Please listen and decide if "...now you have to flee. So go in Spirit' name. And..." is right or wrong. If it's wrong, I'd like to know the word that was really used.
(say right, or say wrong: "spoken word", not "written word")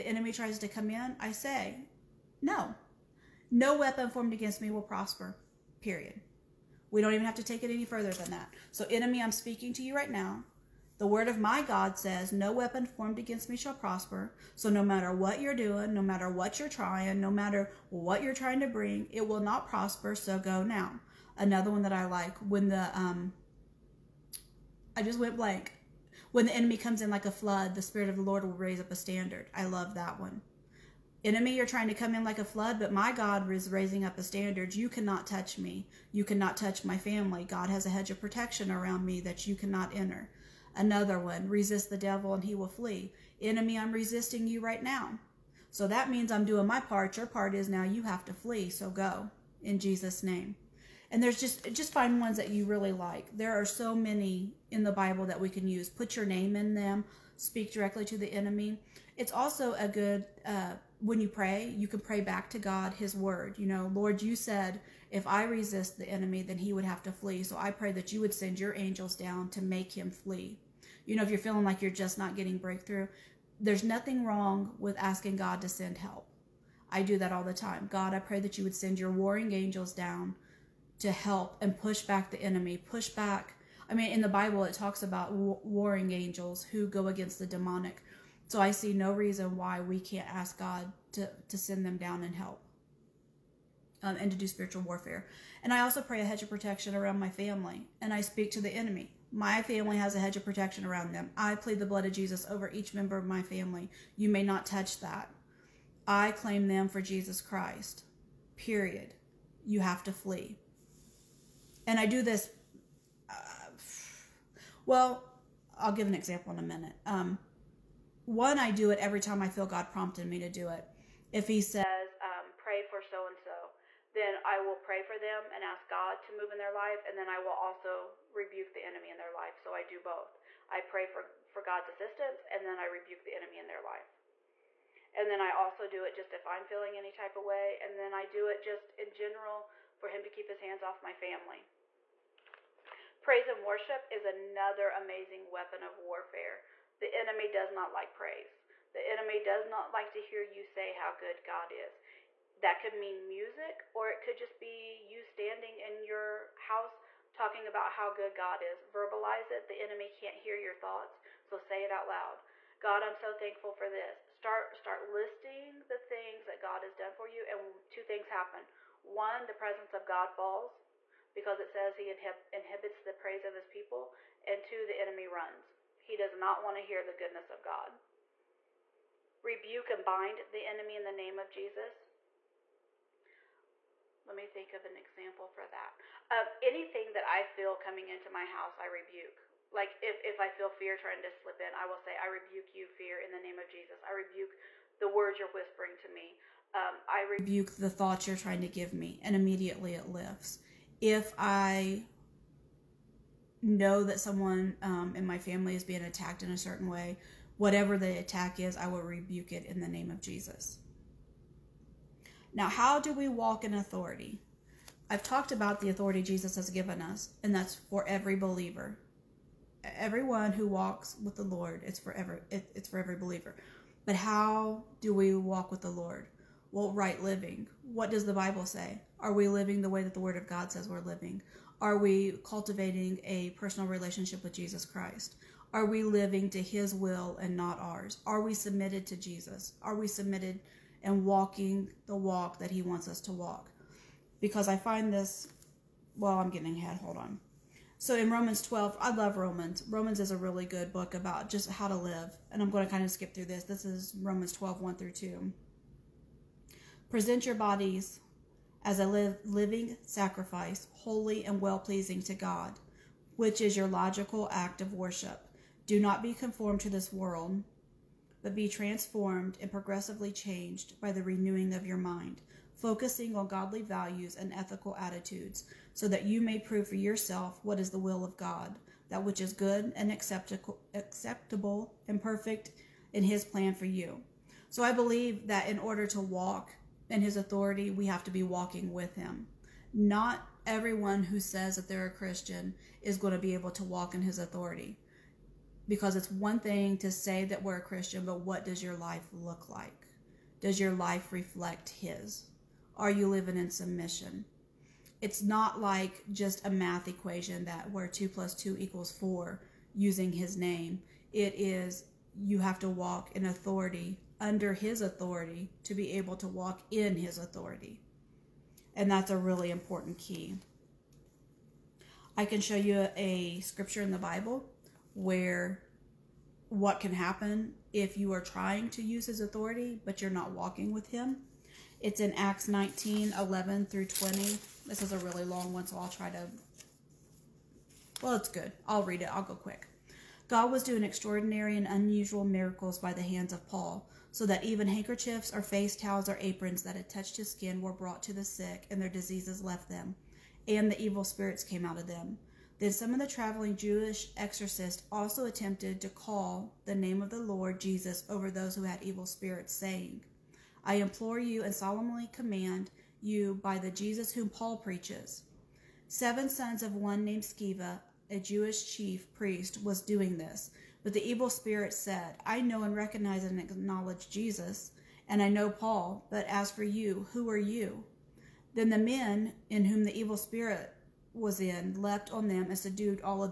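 wrong: "Jesus", not "Spirit".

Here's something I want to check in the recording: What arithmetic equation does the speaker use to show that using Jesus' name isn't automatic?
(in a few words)
2 plus 2 equals 4.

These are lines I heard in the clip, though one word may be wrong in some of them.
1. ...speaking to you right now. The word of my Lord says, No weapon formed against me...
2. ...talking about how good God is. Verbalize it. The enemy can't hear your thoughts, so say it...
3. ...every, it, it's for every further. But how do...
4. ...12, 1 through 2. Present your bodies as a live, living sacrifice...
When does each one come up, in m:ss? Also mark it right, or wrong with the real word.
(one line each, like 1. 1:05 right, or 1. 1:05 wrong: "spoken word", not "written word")
1. 0:09 wrong: "God", not "Lord"
2. 2:37 right
3. 3:42 wrong: "believer", not "further"
4. 4:14 right.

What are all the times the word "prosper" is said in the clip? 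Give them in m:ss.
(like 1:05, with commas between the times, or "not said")
0:04, 0:13, 0:19.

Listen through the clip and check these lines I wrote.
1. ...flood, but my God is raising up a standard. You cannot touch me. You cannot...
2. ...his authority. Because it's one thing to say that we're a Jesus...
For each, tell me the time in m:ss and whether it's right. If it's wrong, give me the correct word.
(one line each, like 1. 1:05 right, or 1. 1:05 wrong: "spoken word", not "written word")
1. 0:32 right
2. 4:54 wrong: "Christian", not "Jesus".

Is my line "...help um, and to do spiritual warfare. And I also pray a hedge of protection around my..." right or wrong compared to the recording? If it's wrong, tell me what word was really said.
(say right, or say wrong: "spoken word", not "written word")
right.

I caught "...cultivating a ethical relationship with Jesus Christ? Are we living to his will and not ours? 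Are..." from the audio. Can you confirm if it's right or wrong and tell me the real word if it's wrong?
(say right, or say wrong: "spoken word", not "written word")
wrong: "personal", not "ethical".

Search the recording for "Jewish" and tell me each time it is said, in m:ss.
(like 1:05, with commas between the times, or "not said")
5:53, 6:08.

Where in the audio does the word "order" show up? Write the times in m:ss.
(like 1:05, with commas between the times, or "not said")
4:45.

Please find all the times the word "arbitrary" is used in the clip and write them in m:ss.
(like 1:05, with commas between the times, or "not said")
not said.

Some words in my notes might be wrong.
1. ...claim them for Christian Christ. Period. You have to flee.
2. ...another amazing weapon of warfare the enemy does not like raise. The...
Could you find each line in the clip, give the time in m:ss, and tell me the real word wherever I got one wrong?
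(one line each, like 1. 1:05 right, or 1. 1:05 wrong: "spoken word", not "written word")
1. 1:46 wrong: "Jesus", not "Christian"
2. 2:24 wrong: "praise", not "raise".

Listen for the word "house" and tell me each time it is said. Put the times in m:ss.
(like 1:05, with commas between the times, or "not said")
2:36, 3:08.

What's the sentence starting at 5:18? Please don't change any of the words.
And that's a really important key.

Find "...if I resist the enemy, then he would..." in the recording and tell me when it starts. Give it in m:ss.
1:05.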